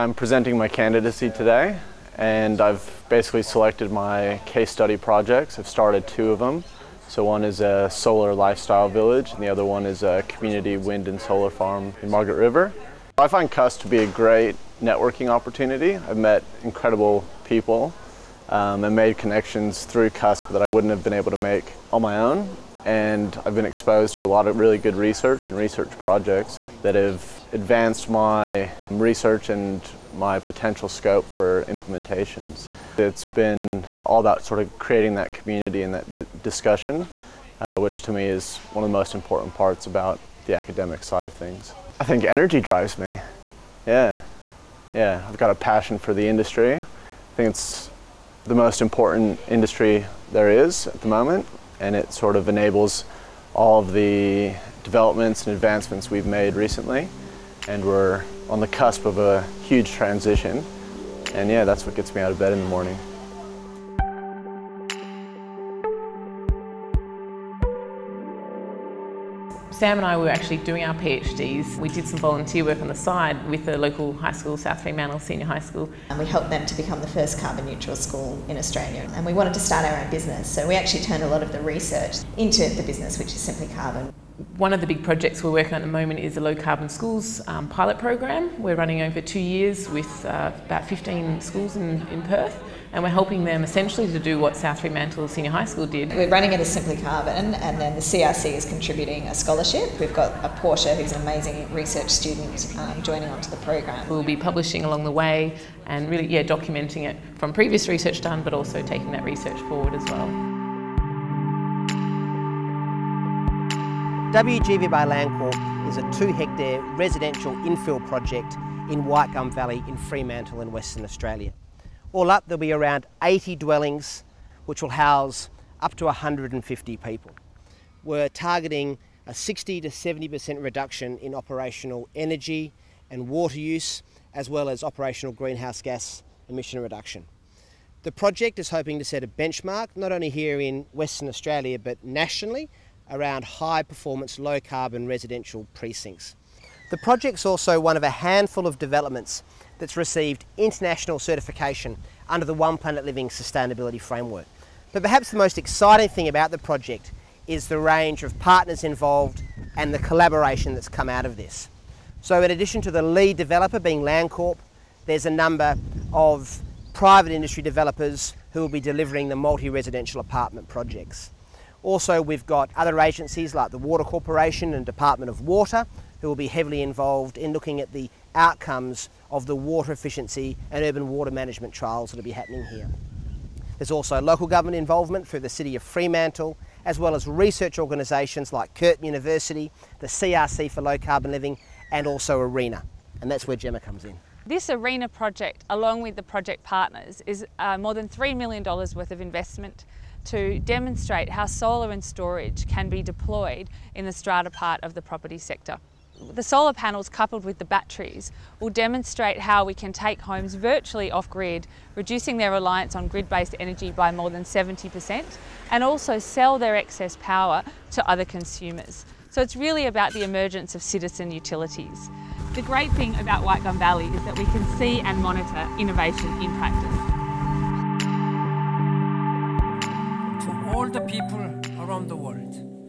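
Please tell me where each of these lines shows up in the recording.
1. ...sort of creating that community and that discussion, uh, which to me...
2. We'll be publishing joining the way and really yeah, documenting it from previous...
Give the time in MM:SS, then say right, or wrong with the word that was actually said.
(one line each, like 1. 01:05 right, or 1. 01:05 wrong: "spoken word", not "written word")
1. 00:34 right
2. 01:44 wrong: "along", not "joining".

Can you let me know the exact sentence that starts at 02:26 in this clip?
The project's also one of a handful of developments that's received international certification under the One Planet Living Sustainability Framework.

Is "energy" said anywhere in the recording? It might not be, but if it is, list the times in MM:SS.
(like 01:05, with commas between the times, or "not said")
00:42, 02:12, 03:33.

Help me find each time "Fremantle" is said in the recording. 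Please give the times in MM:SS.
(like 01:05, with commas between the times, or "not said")
01:14, 01:34, 01:59, 03:05.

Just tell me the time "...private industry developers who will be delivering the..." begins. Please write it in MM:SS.
02:46.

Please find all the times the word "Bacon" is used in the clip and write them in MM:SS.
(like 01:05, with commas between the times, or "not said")
not said.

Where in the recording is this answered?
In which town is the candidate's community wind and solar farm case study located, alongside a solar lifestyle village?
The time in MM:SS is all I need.
00:12.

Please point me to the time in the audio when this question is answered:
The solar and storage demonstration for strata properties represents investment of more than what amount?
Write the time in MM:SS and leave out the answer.
03:18.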